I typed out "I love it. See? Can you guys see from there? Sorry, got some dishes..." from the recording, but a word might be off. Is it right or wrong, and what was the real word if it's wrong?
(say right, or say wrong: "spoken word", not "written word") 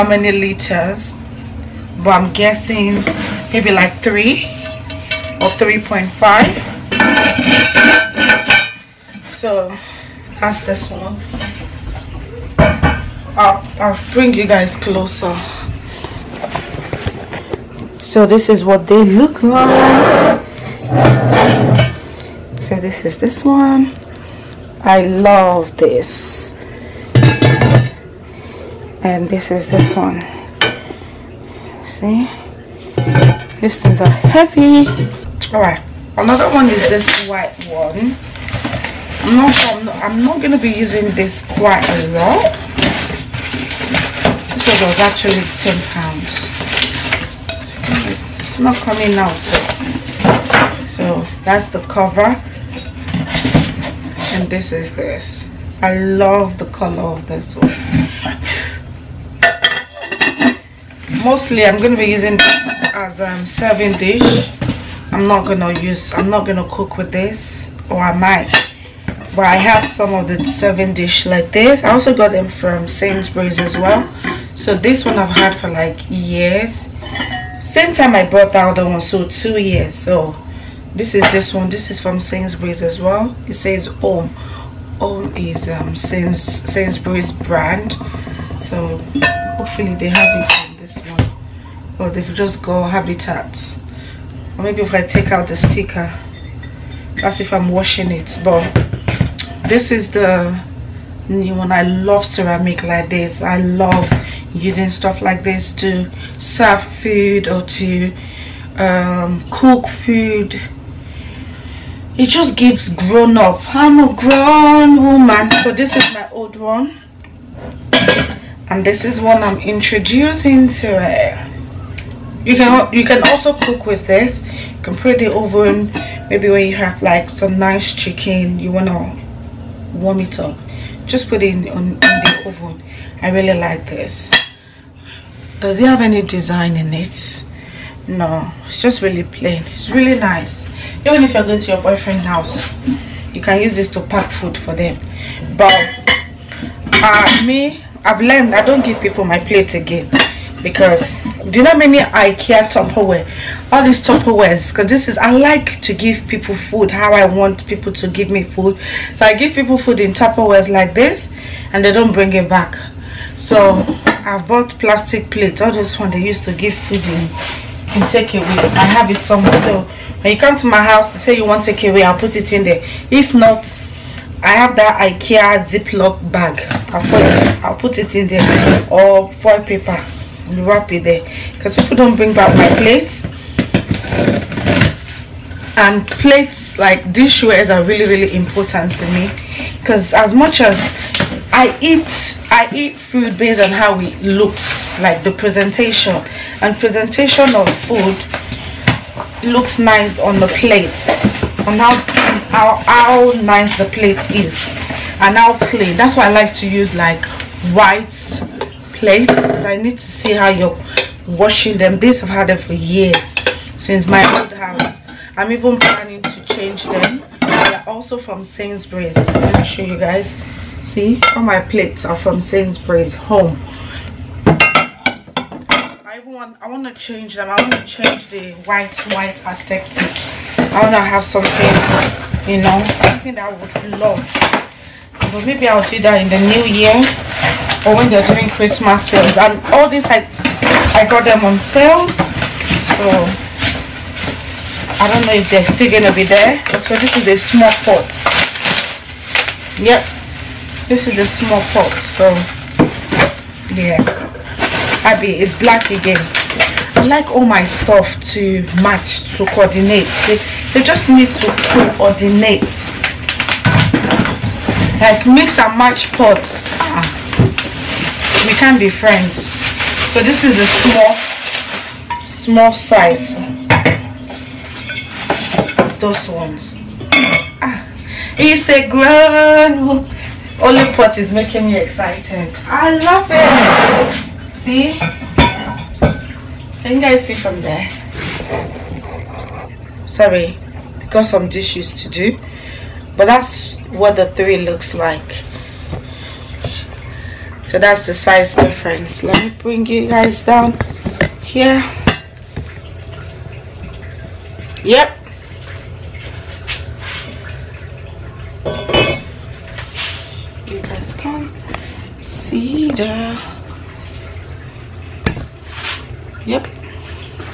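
right.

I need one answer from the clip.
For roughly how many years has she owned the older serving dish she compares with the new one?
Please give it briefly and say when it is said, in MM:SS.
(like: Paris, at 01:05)
2, at 01:19.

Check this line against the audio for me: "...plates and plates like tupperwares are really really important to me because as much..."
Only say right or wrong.
wrong.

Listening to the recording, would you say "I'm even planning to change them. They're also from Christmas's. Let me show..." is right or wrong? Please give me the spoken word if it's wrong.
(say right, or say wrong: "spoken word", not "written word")
wrong: "Sainsbury", not "Christmas".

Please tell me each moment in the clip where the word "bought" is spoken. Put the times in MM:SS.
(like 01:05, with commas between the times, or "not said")
01:18, 02:44.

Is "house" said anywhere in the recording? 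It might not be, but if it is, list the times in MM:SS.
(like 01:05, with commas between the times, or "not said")
02:22, 02:50, 03:34.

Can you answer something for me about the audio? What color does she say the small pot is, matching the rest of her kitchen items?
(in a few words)
Black.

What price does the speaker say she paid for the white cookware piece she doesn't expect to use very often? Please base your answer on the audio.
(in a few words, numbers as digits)
£10.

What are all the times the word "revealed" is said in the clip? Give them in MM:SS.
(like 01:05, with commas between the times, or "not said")
not said.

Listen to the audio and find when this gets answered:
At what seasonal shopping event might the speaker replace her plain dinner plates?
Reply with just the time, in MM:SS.
03:58.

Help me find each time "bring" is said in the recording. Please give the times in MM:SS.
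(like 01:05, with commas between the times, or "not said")
00:14, 02:42, 03:02, 04:59.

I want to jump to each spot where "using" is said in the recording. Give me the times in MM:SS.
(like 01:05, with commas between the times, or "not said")
00:40, 01:02, 01:44.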